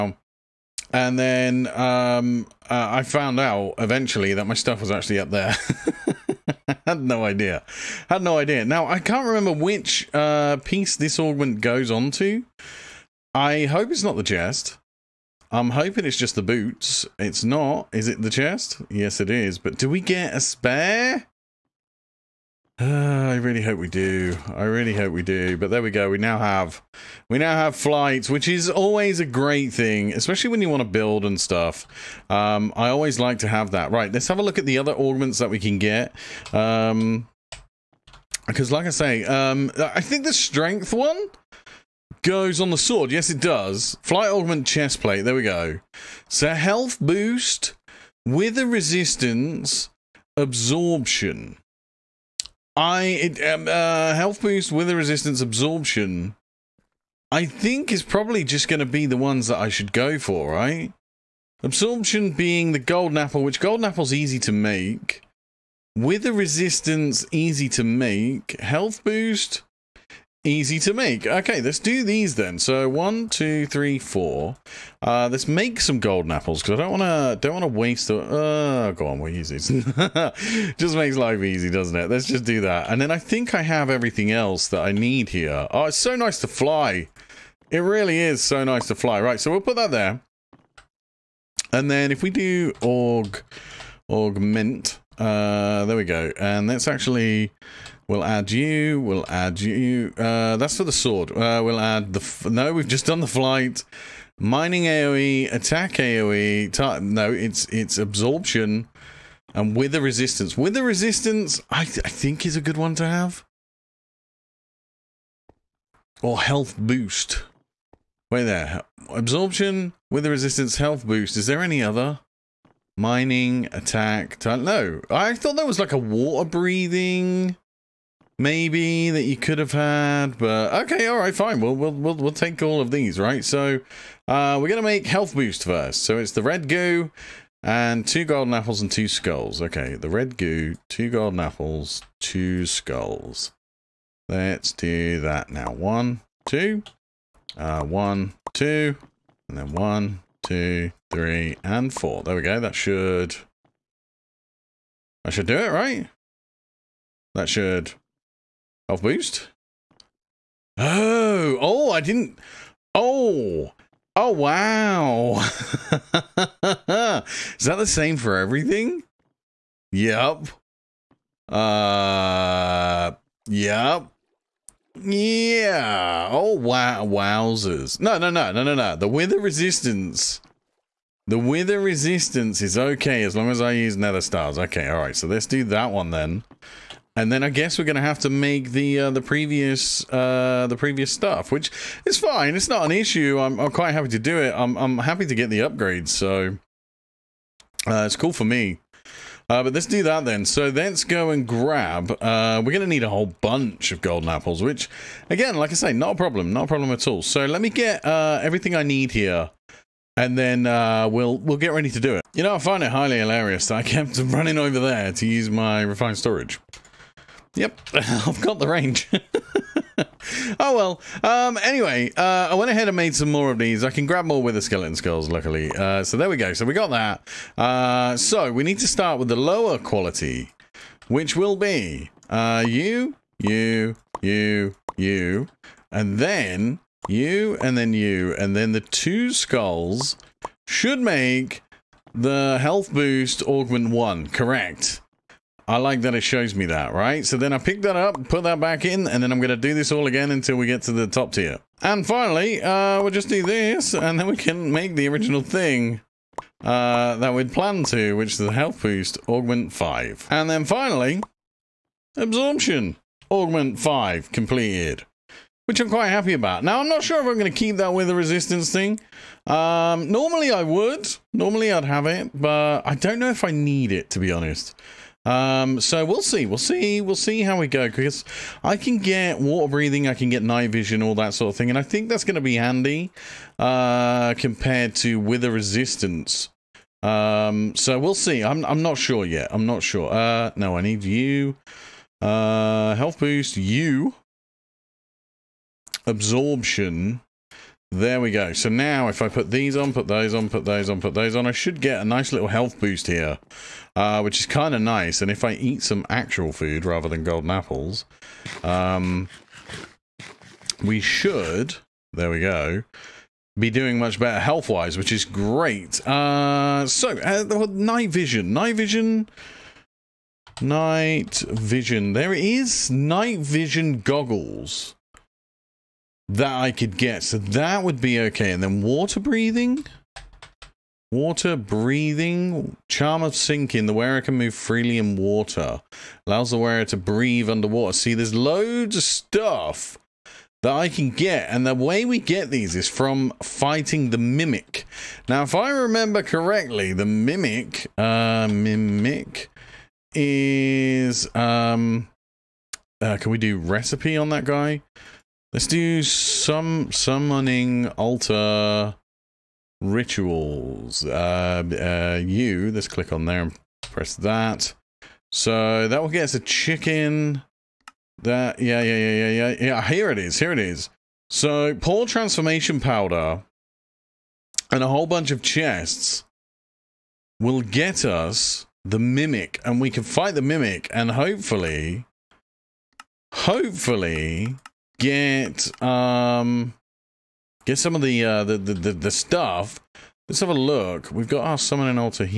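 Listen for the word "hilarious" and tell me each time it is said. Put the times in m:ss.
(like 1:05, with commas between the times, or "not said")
3:33.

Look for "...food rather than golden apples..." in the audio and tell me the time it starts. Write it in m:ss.
5:06.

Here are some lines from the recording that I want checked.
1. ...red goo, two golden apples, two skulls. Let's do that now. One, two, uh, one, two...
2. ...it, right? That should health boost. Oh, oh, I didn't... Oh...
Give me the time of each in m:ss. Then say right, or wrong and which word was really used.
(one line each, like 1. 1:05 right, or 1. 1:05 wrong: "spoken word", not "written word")
1. 2:20 right
2. 2:35 right.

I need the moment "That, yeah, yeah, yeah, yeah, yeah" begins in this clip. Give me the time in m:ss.
6:08.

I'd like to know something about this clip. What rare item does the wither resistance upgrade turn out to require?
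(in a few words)
Nether stars.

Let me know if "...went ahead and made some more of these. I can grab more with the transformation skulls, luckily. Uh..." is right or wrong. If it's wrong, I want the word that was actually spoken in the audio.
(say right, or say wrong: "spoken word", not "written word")
wrong: "skeleton", not "transformation".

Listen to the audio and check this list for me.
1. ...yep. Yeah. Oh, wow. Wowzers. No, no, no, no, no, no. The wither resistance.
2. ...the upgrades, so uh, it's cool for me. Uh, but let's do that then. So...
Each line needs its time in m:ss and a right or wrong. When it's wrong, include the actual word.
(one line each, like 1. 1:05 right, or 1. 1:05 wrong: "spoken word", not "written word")
1. 2:53 right
2. 3:15 right.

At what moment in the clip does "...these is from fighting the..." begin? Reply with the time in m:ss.
5:42.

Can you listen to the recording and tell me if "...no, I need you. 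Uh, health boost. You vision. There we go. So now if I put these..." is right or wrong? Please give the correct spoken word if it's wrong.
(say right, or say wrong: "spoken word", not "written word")
wrong: "absorption", not "vision".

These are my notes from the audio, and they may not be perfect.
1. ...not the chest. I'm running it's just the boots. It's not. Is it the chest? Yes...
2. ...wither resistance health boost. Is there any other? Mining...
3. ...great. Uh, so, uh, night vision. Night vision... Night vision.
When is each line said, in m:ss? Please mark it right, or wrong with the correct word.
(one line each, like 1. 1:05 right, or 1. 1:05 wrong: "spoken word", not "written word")
1. 0:14 wrong: "hoping", not "running"
2. 2:00 right
3. 5:15 right.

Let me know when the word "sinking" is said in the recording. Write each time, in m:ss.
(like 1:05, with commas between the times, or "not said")
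5:33.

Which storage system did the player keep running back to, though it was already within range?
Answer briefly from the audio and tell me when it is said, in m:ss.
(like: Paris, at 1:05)
Refined storage, at 3:35.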